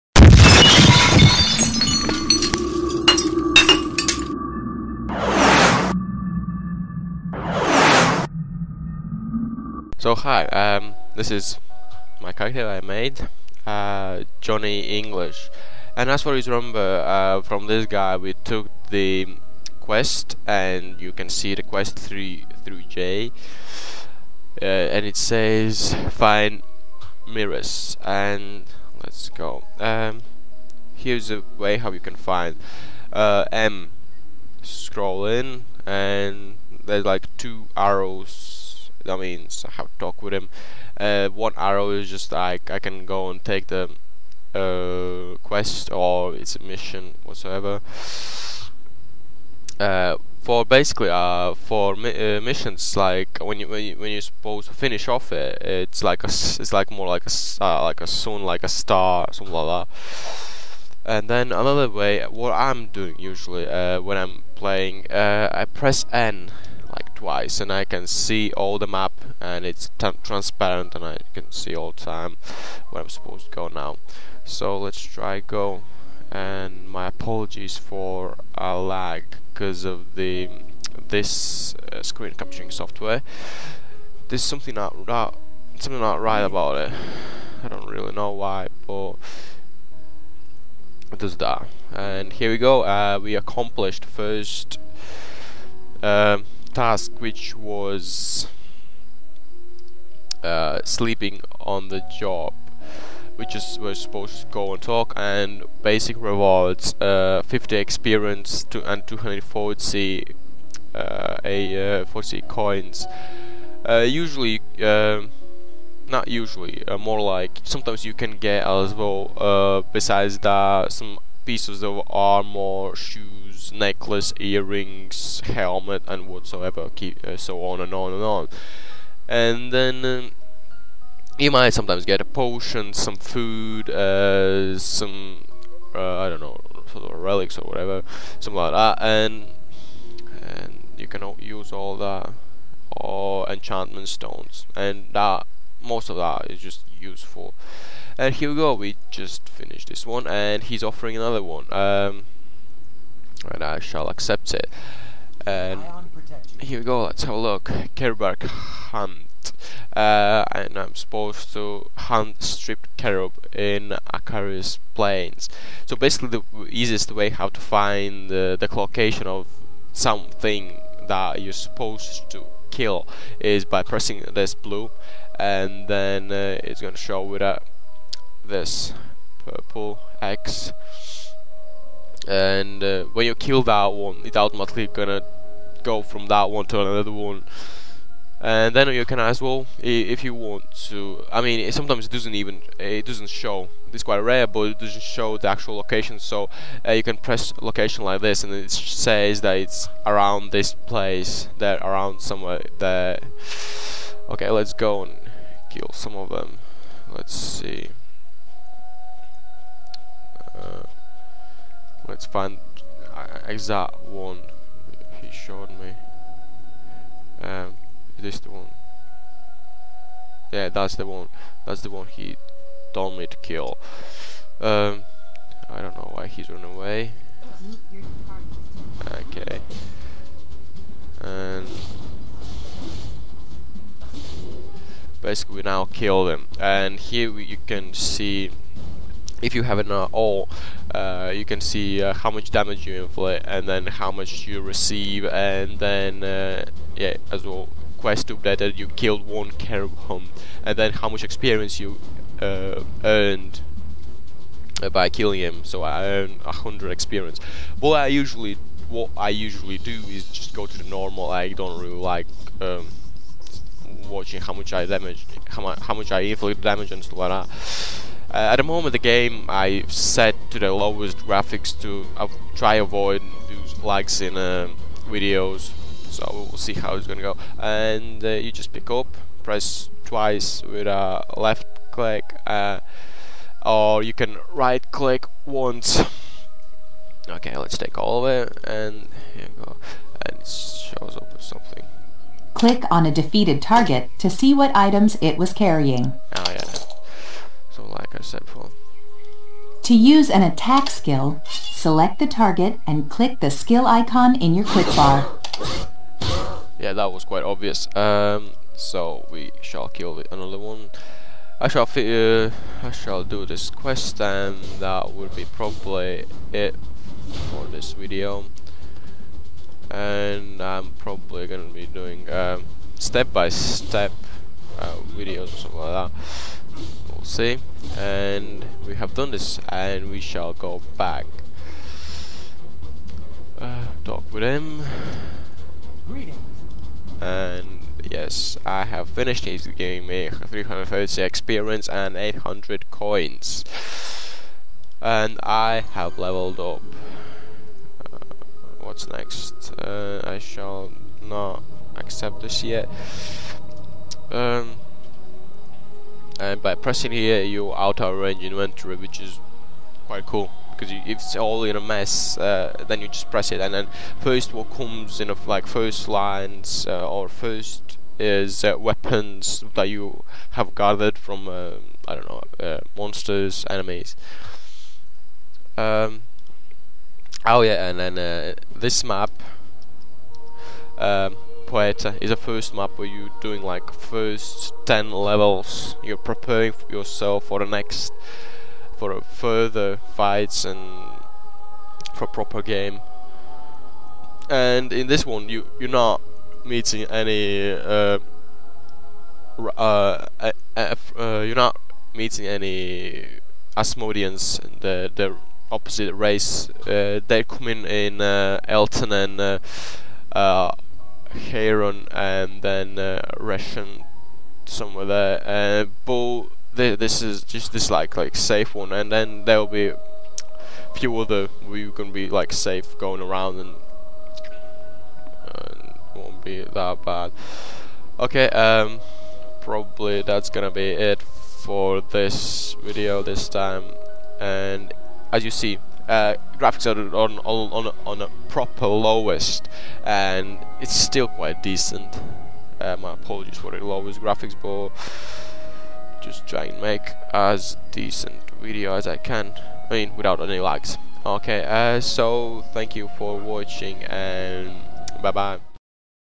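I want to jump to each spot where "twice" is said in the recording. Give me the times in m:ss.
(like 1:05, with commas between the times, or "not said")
1:07, 4:40.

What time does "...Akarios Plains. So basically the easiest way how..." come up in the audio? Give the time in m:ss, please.
2:44.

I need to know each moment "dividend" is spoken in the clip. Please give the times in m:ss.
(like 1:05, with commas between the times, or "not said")
not said.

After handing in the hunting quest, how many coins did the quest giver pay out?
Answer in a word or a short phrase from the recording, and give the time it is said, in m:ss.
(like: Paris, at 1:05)
800, at 5:42.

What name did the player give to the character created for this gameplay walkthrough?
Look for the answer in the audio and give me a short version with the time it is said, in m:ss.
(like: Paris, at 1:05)
Johnny English, at 0:14.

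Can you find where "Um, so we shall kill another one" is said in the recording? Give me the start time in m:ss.
5:07.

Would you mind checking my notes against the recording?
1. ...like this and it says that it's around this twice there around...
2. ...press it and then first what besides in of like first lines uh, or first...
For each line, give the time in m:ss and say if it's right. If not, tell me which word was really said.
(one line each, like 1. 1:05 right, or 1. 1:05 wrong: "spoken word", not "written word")
1. 3:18 wrong: "place", not "twice"
2. 6:03 wrong: "comes", not "besides".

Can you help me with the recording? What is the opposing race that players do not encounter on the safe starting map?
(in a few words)
Asmodians.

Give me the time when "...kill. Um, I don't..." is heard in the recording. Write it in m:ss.
3:43.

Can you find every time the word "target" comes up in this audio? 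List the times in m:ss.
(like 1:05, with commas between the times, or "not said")
4:53, 5:02.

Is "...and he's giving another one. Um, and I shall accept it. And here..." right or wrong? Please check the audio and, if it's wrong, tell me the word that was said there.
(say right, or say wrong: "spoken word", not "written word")
wrong: "offering", not "giving".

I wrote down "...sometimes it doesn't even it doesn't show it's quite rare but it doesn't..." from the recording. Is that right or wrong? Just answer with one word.
right.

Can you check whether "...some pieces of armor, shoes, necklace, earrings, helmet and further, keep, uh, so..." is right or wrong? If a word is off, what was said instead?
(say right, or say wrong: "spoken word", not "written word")
wrong: "whatsoever", not "further".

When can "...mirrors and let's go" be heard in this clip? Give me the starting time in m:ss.
0:27.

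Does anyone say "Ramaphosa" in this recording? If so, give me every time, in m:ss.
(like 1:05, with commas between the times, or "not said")
not said.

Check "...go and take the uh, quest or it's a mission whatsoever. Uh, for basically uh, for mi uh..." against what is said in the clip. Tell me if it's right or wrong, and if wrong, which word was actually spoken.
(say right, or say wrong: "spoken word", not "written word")
right.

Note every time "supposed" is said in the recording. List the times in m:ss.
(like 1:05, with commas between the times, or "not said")
0:54, 1:13, 1:43, 2:40, 2:51.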